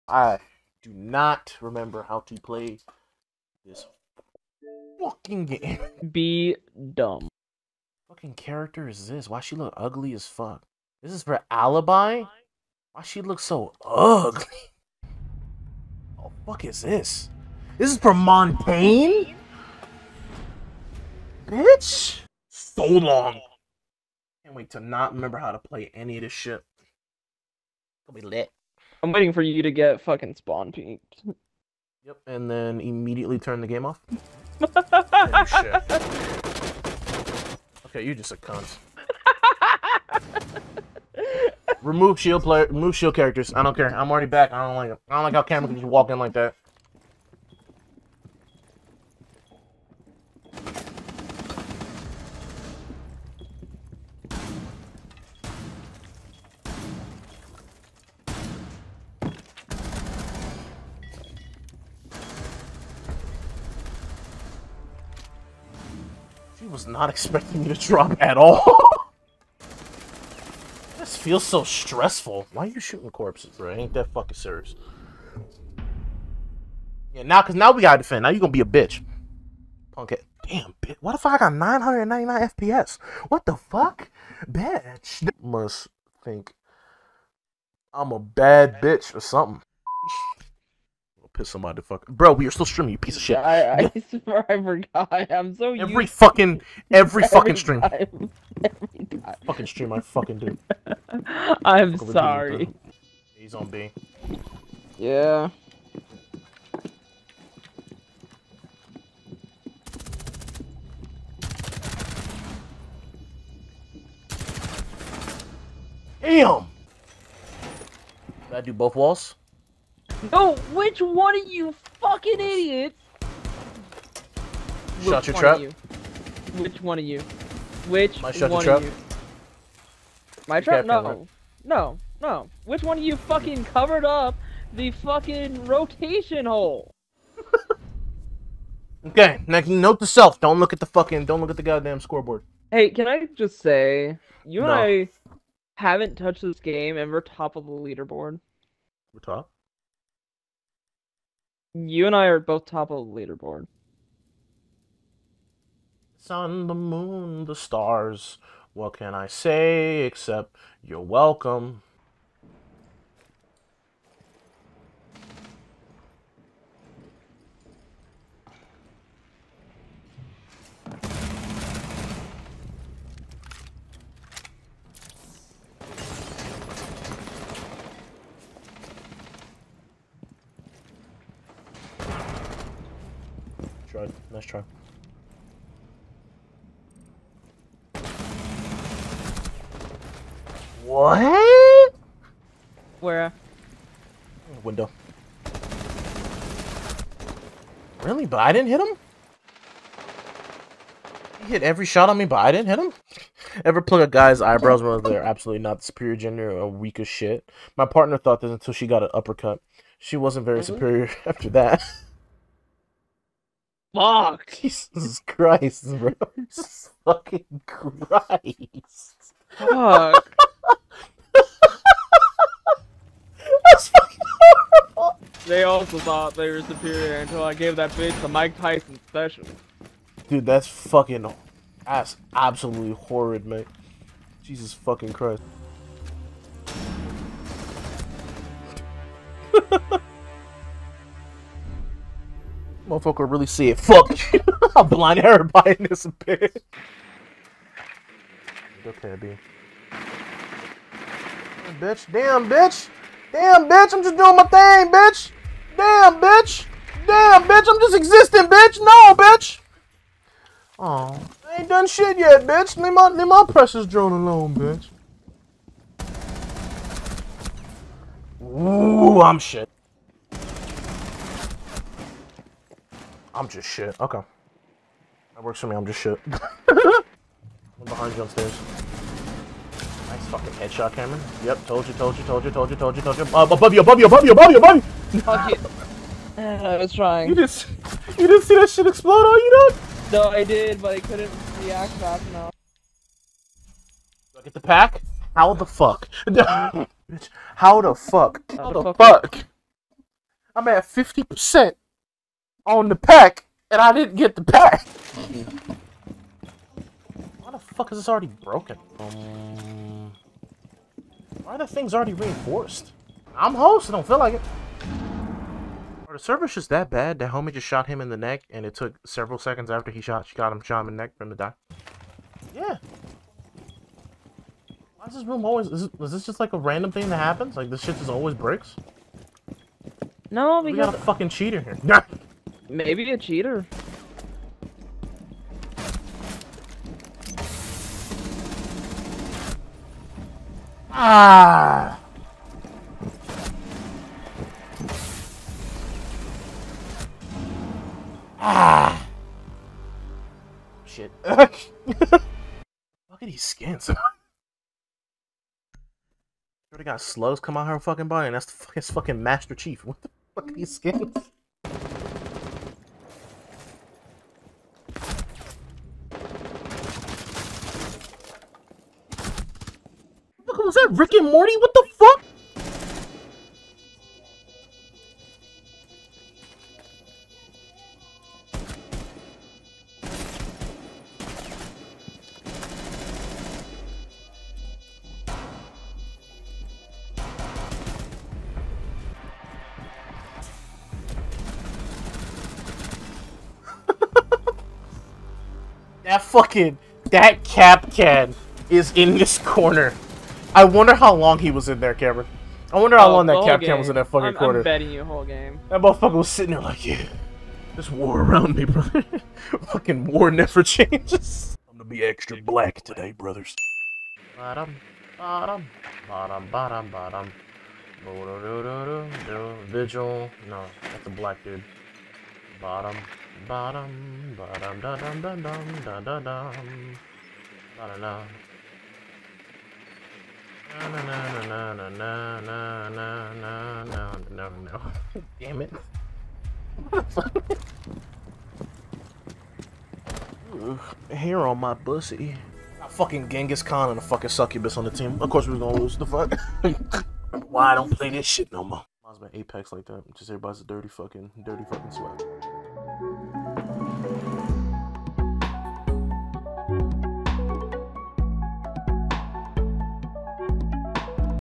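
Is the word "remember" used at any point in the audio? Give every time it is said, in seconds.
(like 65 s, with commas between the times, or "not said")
1 s, 25 s.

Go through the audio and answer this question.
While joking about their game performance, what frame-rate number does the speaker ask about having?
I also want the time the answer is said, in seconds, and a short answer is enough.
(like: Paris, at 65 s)
999 FPS, at 81 s.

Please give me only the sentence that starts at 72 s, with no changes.
Why are you shooting corpses, bro?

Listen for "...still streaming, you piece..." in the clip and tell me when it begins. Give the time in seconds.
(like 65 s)
92 s.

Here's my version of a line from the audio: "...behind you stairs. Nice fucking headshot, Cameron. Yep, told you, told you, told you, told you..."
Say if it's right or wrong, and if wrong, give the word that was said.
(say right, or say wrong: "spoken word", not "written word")
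right.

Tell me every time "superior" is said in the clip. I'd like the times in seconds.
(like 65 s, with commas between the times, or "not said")
205 s, 210 s, 226 s.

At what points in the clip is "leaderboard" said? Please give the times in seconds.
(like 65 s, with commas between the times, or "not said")
147 s, 153 s.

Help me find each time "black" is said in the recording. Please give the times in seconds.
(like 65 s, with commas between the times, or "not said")
412 s, 421 s.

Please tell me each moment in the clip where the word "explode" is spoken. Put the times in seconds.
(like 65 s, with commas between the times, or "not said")
288 s.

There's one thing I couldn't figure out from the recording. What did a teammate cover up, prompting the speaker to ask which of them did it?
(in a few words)
rotation hole.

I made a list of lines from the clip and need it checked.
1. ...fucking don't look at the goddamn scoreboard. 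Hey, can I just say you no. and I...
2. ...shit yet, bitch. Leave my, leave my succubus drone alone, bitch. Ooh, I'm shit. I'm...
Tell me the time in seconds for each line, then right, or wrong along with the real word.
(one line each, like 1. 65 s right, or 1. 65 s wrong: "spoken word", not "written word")
1. 140 s right
2. 261 s wrong: "precious", not "succubus".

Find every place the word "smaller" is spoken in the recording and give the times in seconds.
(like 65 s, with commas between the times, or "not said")
not said.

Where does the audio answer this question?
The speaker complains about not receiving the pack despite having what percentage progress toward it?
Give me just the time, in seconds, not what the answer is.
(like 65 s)
300 s.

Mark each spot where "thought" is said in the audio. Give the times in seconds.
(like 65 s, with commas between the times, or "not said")
208 s, 225 s.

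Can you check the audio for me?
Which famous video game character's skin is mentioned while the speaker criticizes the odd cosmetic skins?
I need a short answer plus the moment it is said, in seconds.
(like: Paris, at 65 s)
Master Chief, at 359 s.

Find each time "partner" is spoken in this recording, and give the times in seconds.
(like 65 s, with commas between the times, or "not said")
207 s.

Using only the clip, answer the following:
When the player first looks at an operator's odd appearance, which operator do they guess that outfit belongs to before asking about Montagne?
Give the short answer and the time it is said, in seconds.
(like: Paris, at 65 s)
Alibi, at 11 s.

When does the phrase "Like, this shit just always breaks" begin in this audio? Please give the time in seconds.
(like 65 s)
327 s.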